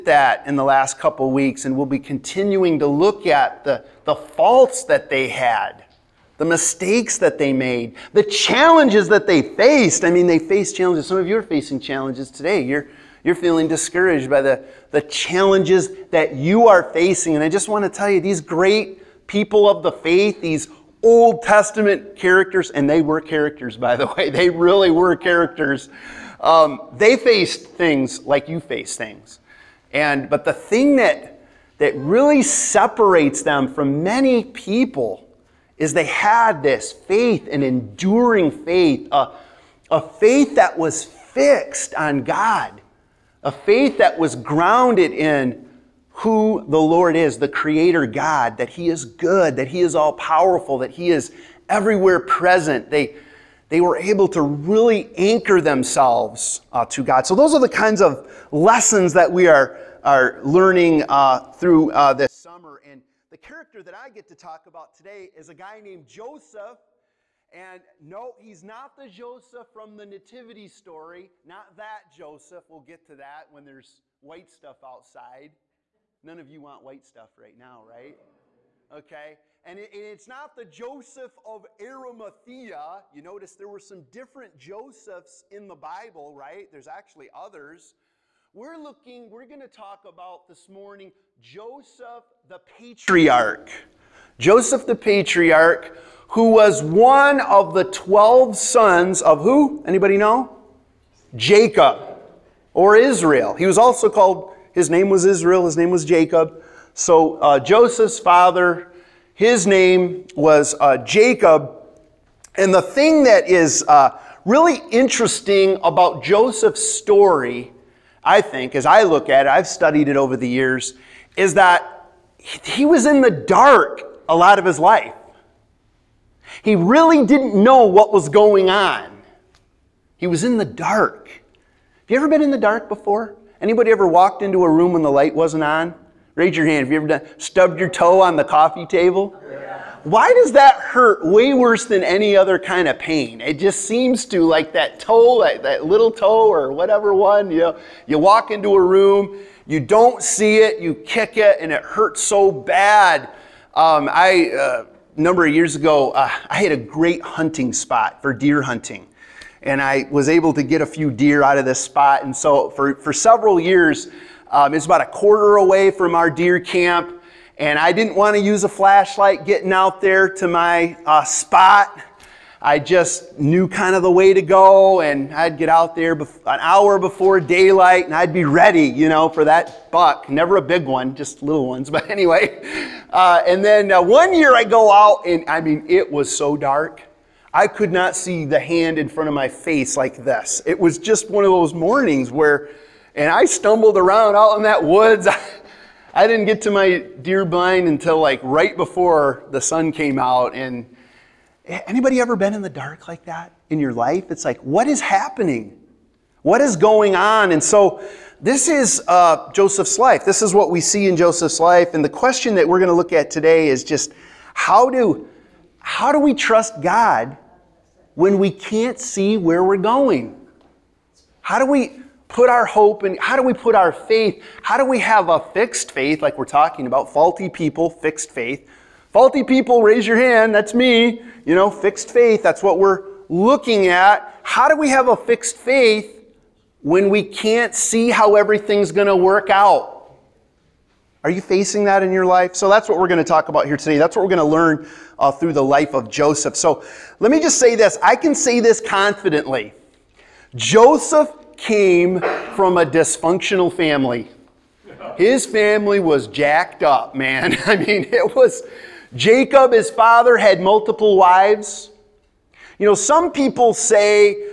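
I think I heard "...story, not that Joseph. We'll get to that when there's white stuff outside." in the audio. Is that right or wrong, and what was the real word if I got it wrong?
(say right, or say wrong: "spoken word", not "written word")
right.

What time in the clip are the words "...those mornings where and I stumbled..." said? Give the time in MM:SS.
03:11.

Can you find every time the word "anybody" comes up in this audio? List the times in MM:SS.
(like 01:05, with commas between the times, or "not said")
01:39, 02:13, 03:21.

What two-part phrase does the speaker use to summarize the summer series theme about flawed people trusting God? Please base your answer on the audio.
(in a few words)
Faulty people, fixed faith.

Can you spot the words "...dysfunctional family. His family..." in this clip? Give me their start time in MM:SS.
04:12.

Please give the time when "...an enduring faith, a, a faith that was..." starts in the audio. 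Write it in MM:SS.
00:37.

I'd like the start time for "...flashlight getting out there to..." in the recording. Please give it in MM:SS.
02:48.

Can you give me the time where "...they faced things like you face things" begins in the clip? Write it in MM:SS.
00:26.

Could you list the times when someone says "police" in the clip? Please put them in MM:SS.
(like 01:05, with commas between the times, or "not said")
not said.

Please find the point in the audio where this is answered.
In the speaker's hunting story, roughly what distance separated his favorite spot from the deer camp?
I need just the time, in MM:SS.
02:45.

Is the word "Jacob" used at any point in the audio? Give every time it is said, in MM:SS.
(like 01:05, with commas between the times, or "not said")
01:41, 01:46, 01:50, 04:19.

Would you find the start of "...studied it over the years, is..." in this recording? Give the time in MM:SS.
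01:59.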